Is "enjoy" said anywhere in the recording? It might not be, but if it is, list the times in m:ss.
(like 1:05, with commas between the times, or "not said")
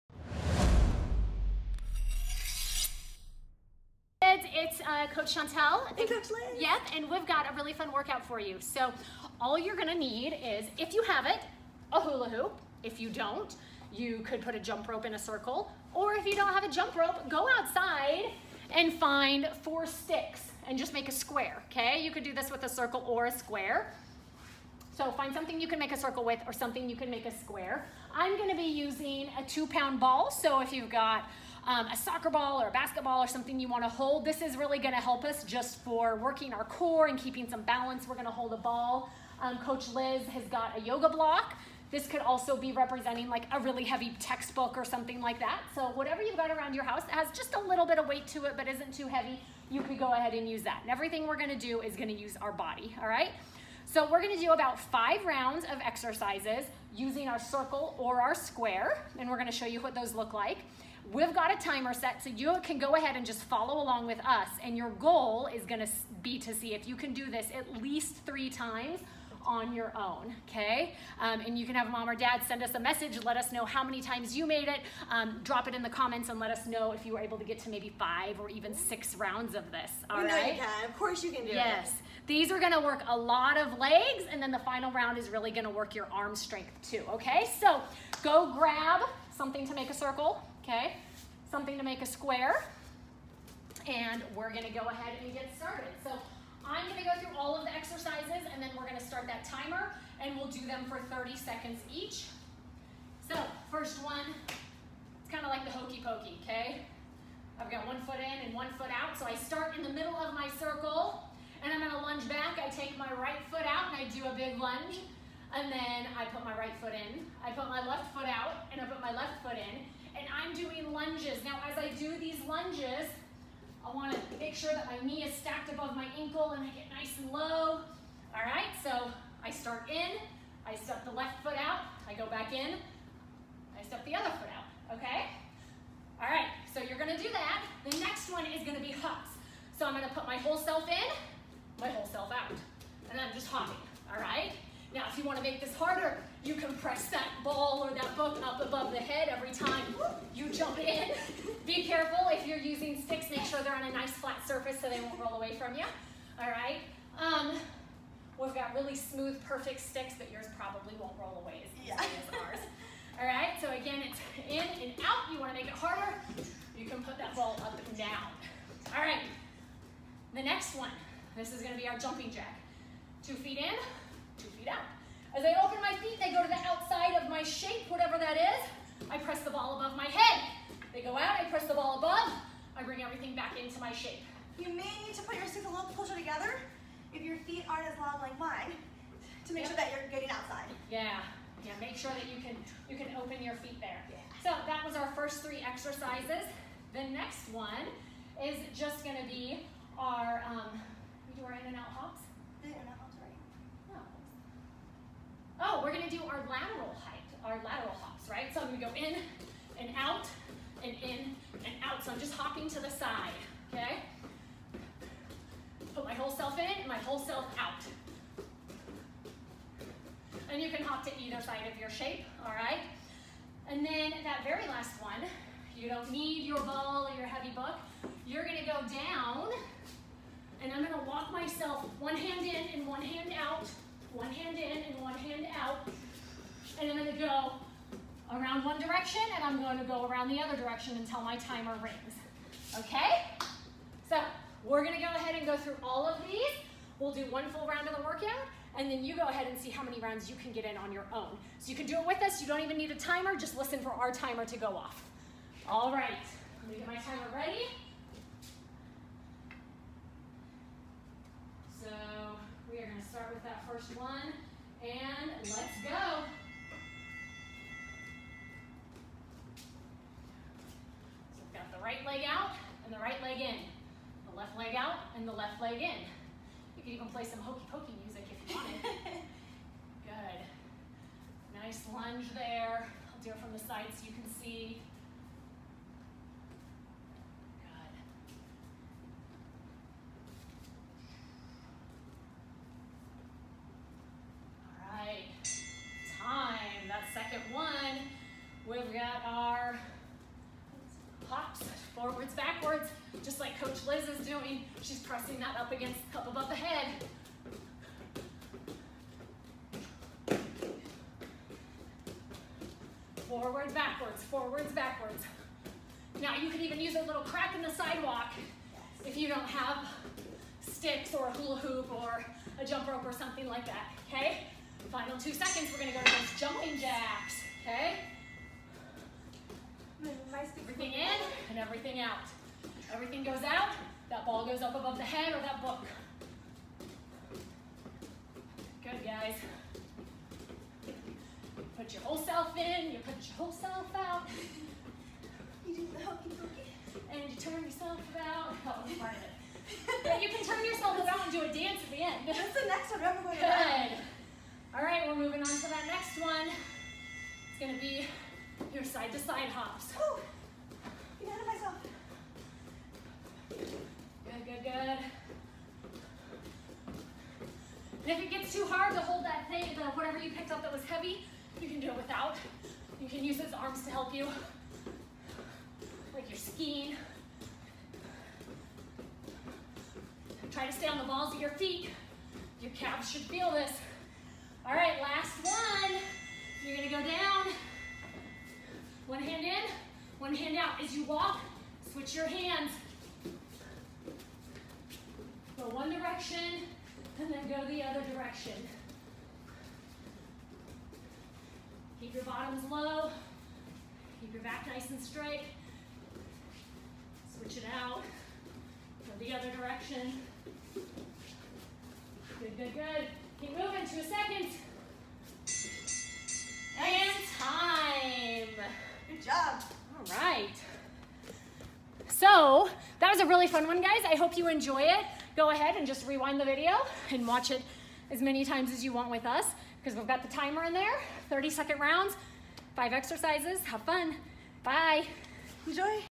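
7:04, 7:15.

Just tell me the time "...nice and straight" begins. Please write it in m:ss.
6:44.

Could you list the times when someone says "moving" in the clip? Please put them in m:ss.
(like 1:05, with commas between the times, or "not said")
5:55, 6:53.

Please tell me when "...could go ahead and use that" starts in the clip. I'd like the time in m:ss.
0:49.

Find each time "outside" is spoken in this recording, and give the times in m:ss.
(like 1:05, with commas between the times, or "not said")
0:17, 2:56, 3:10.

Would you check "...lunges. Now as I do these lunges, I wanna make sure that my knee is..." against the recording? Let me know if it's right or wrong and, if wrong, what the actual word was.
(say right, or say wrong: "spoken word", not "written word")
right.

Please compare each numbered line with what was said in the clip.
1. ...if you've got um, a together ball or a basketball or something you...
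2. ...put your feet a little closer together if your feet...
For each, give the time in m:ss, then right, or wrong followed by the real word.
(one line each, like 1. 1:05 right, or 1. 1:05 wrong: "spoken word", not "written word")
1. 0:30 wrong: "soccer", not "together"
2. 3:05 right.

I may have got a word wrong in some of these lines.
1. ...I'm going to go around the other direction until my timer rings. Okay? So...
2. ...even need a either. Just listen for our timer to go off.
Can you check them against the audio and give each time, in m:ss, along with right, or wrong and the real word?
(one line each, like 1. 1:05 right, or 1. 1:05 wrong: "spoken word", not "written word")
1. 3:59 right
2. 4:12 wrong: "timer", not "either".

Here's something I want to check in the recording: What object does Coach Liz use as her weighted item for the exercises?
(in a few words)
A yoga block.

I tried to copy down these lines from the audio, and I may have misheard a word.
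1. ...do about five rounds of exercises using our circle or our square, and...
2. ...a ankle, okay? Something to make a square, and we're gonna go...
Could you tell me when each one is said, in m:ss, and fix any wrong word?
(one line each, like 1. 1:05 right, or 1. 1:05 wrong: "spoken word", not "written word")
1. 0:54 right
2. 1:29 wrong: "circle", not "ankle".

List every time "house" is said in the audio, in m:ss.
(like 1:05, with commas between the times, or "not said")
0:46.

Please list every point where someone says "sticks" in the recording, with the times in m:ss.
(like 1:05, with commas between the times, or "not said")
0:19, 2:33, 2:39, 5:20.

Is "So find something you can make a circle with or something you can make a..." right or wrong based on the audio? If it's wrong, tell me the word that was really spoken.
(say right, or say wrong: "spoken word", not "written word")
right.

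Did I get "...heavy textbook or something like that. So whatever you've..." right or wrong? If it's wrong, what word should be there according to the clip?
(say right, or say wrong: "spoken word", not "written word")
right.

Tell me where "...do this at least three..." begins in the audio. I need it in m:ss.
1:07.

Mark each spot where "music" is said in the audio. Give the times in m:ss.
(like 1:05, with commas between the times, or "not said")
4:38.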